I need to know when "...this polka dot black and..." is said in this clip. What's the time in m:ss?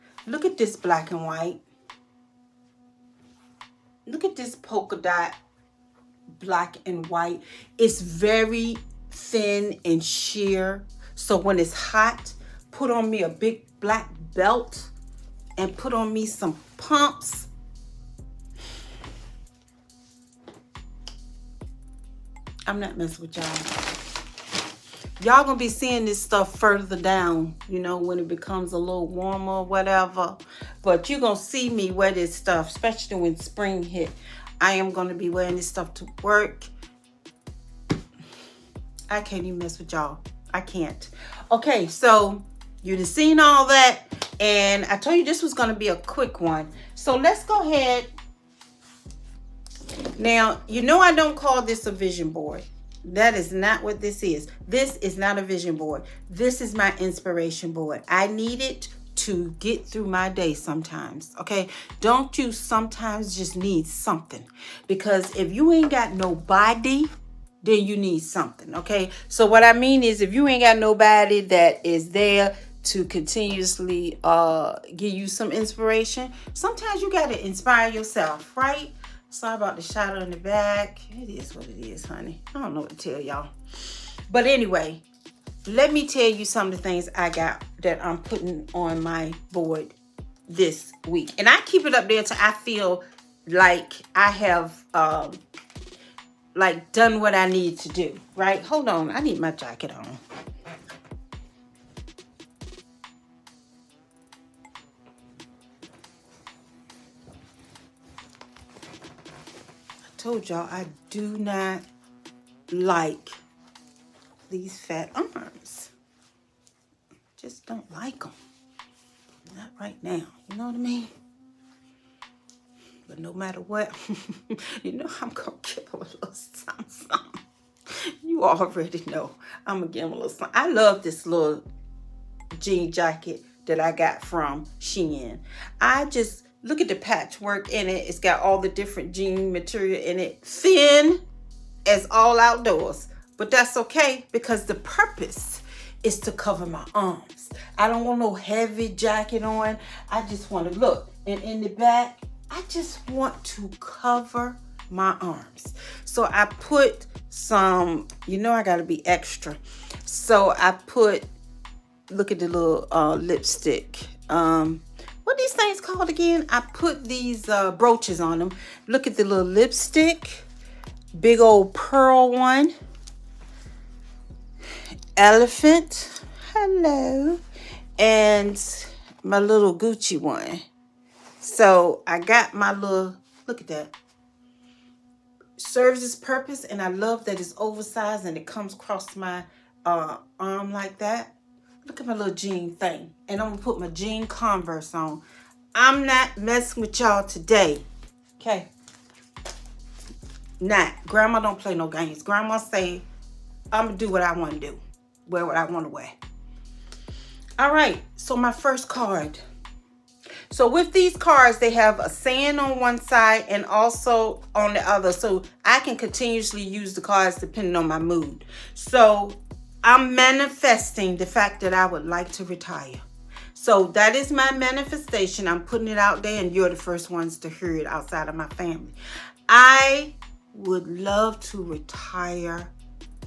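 0:04.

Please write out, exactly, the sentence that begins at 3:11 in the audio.
Look at my little jean thing.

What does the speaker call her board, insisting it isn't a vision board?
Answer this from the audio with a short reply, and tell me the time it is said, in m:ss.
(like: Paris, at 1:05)
Inspiration board, at 0:56.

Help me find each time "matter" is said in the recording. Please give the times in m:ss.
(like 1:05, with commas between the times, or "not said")
2:03.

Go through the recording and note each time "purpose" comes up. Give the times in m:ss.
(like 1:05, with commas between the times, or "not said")
2:24, 3:06.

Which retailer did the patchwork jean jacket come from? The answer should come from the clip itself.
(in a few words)
Shein.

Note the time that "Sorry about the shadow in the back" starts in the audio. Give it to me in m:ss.
1:19.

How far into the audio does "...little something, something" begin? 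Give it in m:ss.
2:06.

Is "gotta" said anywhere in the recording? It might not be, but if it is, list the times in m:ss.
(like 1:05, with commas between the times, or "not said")
2:38.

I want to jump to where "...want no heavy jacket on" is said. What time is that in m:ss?
2:28.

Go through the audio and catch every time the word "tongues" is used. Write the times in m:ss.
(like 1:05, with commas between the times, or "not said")
not said.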